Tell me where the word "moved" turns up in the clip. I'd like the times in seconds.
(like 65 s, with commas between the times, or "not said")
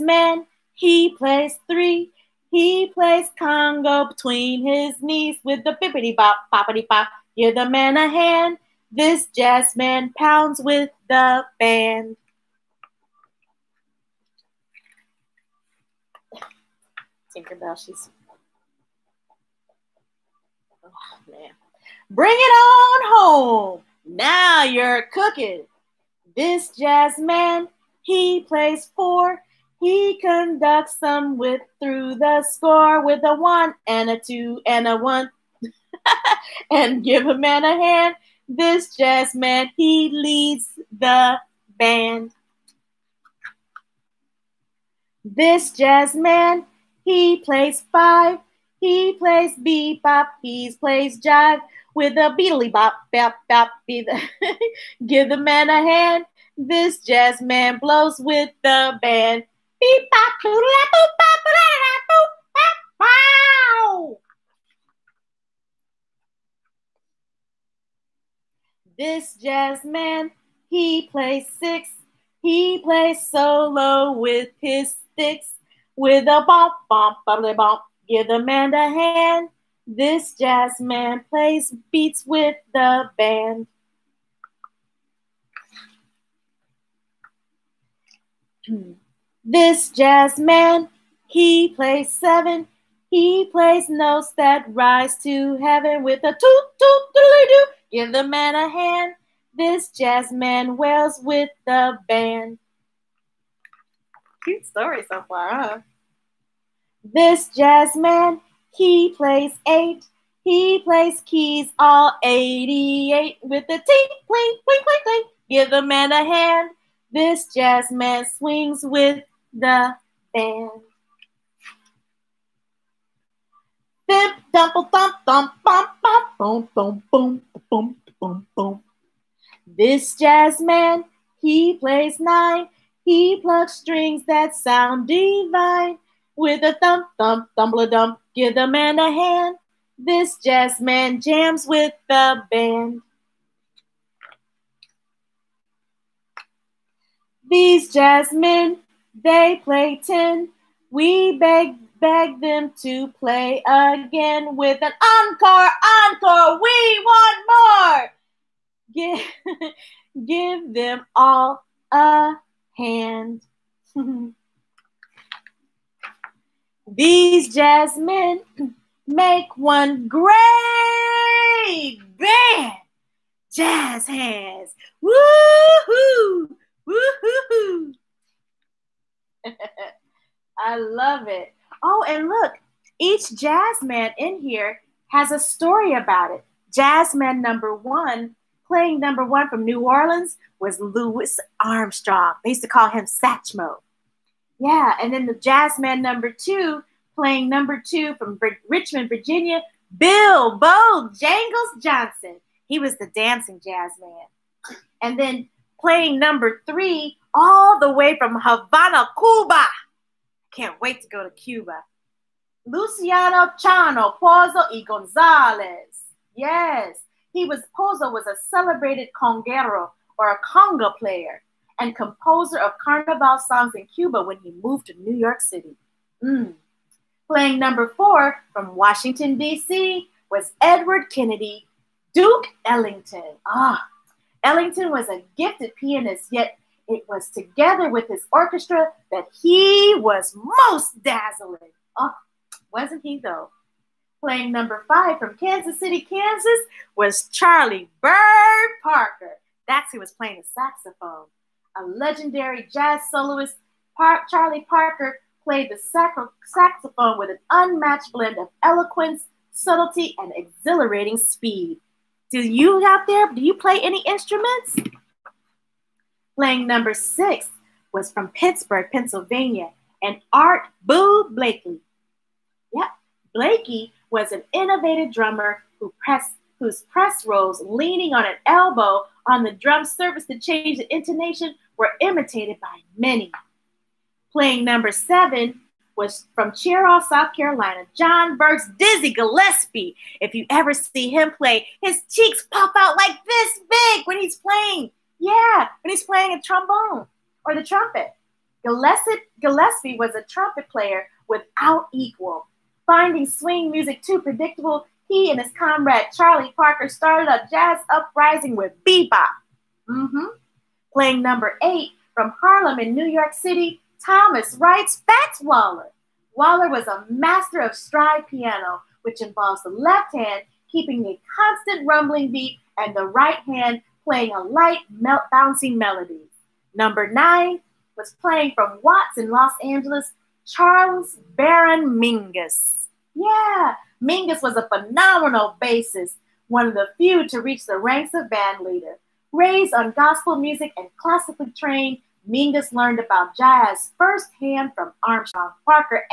224 s.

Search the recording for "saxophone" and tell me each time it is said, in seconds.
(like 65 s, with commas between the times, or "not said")
250 s, 255 s.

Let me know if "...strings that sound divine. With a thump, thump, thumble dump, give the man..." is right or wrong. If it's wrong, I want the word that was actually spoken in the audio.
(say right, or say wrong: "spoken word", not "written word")
right.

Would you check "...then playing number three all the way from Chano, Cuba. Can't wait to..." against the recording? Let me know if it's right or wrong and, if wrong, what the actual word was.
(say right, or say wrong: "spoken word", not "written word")
wrong: "Havana", not "Chano".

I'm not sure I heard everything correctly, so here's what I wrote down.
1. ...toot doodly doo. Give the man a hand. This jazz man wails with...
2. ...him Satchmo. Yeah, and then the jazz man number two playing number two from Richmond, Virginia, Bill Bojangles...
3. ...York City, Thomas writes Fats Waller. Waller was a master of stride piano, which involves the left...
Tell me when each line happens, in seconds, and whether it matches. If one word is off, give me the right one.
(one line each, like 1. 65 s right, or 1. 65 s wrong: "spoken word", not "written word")
1. 96 s right
2. 192 s right
3. 313 s right.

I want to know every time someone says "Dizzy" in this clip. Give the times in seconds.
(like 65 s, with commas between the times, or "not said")
288 s.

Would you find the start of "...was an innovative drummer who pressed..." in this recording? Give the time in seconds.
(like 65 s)
274 s.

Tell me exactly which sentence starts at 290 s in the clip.
If you ever see him play, his cheeks pop out like this big when he's playing.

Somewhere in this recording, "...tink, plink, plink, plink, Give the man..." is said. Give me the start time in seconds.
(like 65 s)
113 s.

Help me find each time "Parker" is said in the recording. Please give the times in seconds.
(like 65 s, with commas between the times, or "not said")
248 s, 254 s, 306 s.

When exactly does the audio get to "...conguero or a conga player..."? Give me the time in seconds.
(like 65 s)
219 s.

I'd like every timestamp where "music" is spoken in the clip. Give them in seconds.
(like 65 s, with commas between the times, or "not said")
303 s, 340 s.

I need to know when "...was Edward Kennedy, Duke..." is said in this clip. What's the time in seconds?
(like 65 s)
230 s.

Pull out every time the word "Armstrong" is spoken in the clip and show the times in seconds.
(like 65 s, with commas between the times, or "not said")
191 s, 345 s.